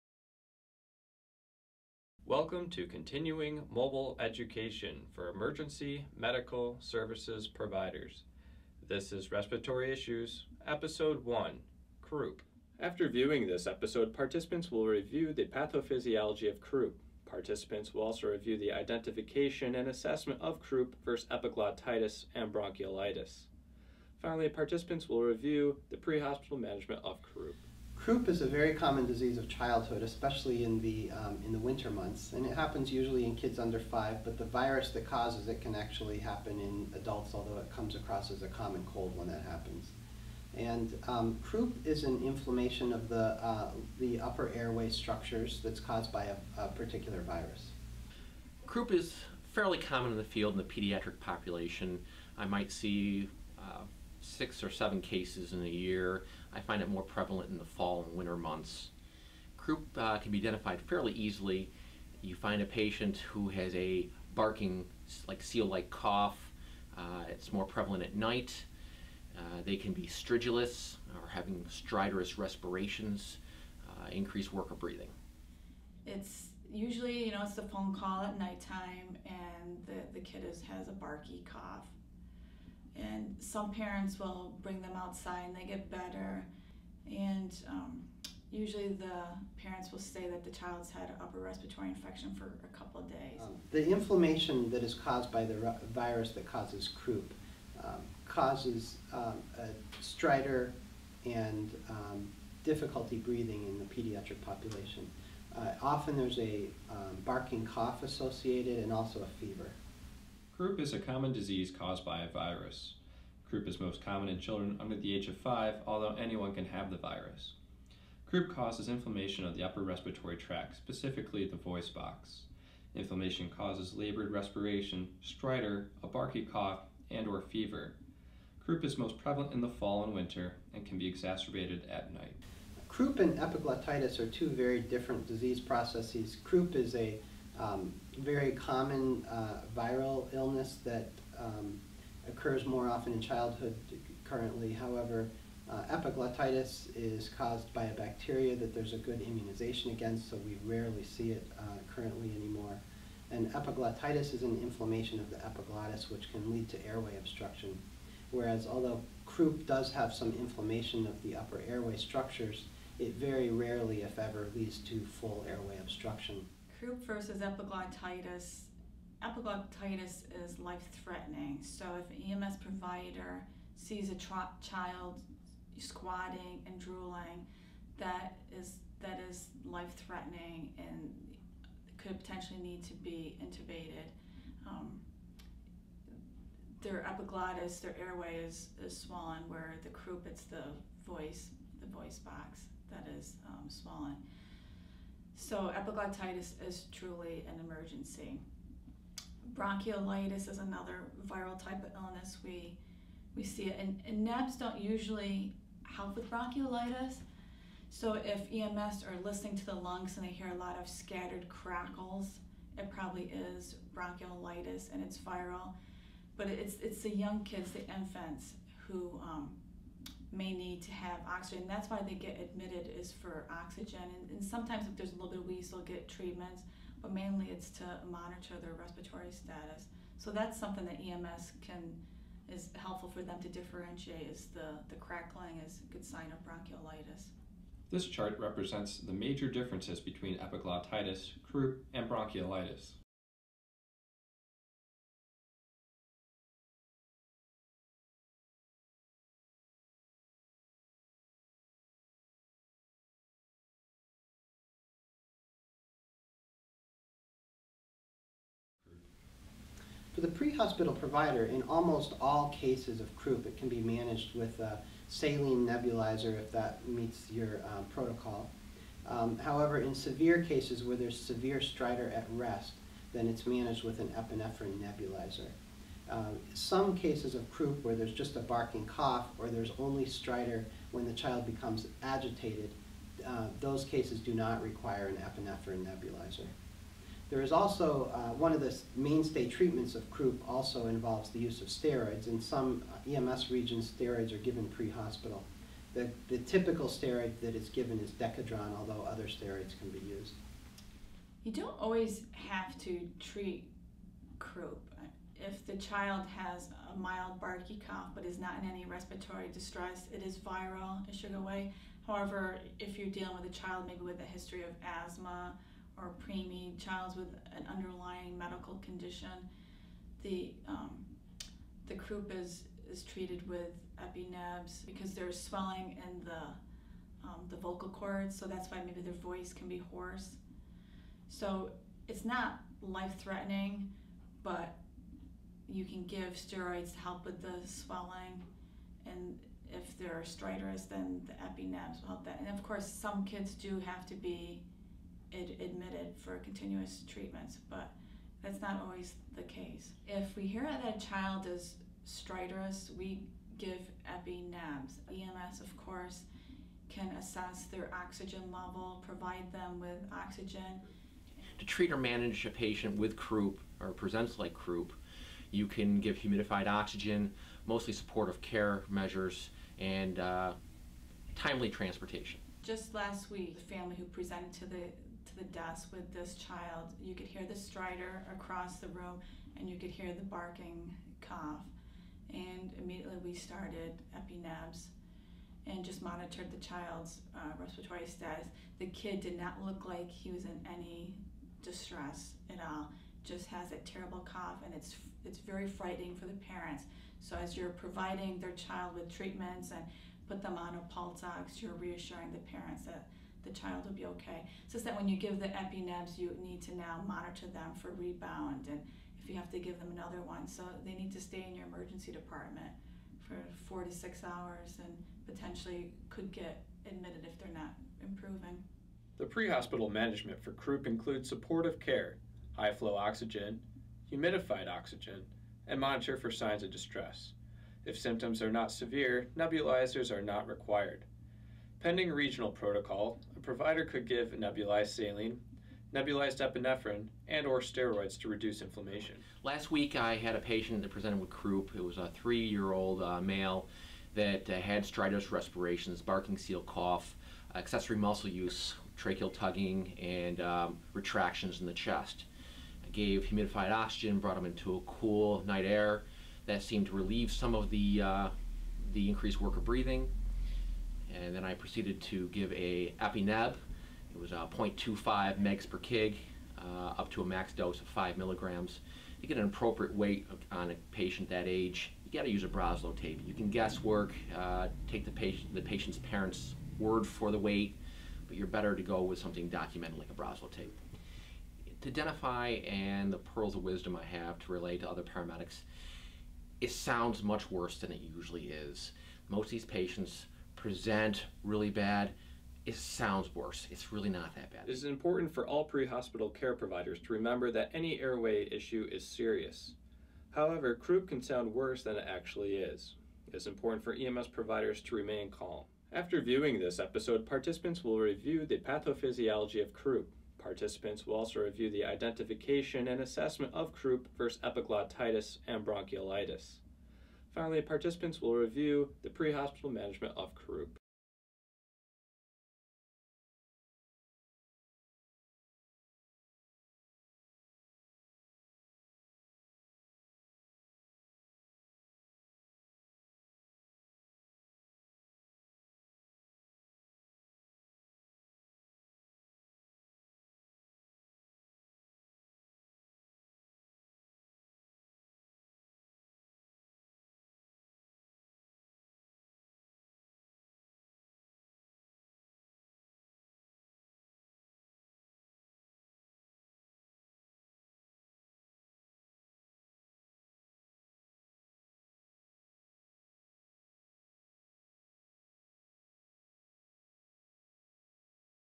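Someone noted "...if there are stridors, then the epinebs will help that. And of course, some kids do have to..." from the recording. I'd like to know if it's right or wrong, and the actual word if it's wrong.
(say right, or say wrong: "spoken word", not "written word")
right.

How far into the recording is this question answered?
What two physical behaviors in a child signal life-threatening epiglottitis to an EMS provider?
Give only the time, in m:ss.
2:55.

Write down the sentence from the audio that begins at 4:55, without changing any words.
The, the typical steroid that is given is Decadron, although other steroids can be used.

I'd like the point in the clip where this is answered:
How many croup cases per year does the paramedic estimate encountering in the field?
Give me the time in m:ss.
0:54.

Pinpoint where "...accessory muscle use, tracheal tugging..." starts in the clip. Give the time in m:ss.
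7:27.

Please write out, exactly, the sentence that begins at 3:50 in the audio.
So that's something that EMS can is helpful for them to differentiate is the, the crackling is a good sign of bronchiolitis.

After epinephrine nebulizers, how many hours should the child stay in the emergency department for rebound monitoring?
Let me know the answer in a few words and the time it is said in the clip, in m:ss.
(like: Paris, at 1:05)
4 to 6 hours, at 6:53.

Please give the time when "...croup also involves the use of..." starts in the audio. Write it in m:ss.
4:50.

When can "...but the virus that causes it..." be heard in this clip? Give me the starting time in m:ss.
0:34.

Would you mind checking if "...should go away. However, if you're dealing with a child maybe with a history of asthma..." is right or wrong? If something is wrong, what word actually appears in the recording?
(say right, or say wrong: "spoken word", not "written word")
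right.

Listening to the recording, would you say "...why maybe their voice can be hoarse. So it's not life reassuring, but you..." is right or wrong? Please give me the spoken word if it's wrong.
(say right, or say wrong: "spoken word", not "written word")
wrong: "threatening", not "reassuring".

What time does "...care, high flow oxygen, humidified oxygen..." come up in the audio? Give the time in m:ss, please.
7:01.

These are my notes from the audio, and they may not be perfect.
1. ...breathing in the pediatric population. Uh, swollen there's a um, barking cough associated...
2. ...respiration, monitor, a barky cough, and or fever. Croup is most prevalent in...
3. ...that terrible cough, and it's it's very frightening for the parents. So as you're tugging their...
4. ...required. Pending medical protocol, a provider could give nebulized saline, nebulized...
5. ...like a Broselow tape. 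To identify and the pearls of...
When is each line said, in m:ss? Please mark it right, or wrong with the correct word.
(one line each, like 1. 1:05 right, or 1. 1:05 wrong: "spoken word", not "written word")
1. 1:43 wrong: "often", not "swollen"
2. 2:04 wrong: "stridor", not "monitor"
3. 6:33 wrong: "providing", not "tugging"
4. 7:10 wrong: "regional", not "medical"
5. 7:59 right.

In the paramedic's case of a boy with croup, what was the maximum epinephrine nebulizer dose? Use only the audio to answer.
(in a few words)
5 milligrams.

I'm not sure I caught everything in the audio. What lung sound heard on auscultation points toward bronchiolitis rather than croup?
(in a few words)
Scattered crackles.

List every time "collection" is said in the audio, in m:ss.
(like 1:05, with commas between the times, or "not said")
not said.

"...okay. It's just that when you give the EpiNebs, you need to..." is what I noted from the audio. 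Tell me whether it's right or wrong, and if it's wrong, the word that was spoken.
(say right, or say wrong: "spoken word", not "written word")
right.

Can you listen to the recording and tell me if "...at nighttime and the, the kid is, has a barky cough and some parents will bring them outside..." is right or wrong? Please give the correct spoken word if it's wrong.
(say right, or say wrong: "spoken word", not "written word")
right.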